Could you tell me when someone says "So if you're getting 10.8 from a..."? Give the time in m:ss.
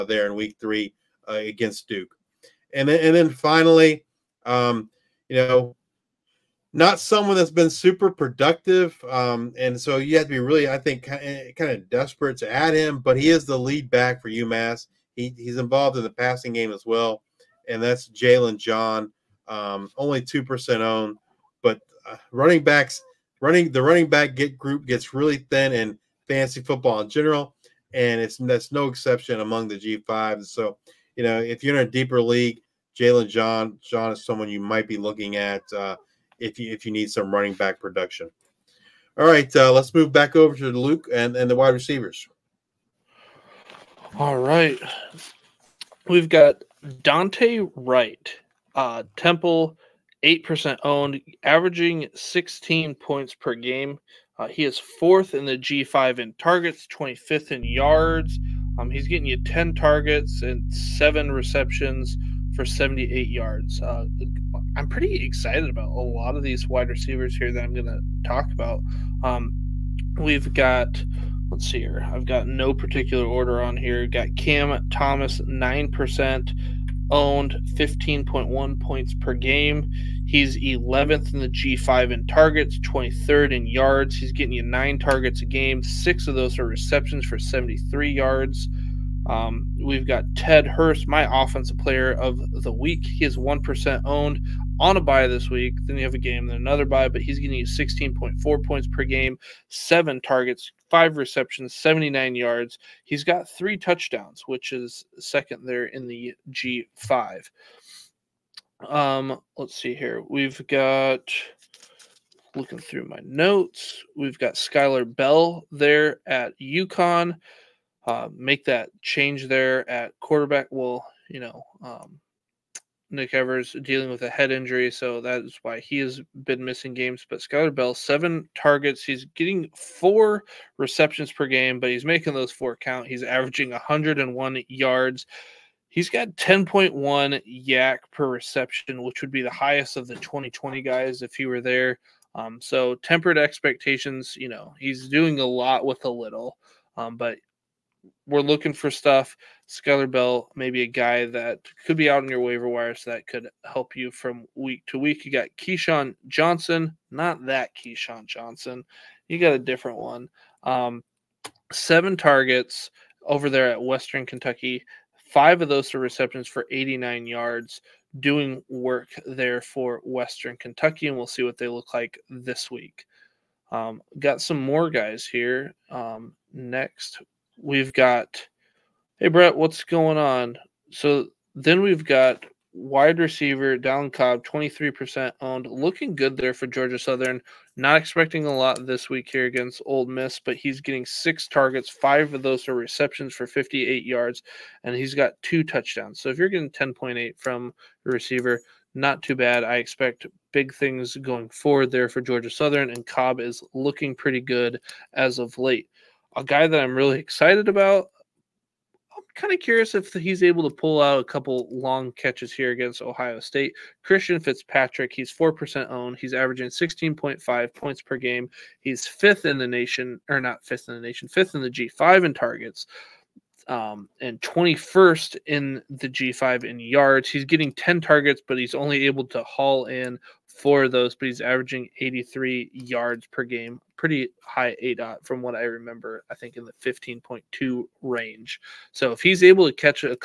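3:16.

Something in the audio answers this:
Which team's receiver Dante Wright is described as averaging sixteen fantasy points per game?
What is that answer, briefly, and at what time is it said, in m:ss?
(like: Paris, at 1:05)
Temple, at 0:49.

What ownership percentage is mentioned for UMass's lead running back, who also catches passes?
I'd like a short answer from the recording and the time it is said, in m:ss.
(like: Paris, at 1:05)
2%, at 0:20.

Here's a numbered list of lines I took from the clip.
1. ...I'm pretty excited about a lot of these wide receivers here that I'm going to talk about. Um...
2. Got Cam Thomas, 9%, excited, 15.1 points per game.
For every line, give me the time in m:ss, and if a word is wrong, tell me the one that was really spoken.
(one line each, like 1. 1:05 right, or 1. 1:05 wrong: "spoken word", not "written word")
1. 1:04 right
2. 1:14 wrong: "owned", not "excited".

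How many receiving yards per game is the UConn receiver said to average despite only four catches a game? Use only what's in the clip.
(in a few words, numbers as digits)
101.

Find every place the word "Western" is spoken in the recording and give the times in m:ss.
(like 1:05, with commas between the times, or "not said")
2:43, 2:50.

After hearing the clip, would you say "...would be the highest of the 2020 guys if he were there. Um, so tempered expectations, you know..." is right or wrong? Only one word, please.
right.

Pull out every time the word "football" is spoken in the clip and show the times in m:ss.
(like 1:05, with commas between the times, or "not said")
0:26.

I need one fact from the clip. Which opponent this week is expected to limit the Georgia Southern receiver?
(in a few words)
Ole Miss.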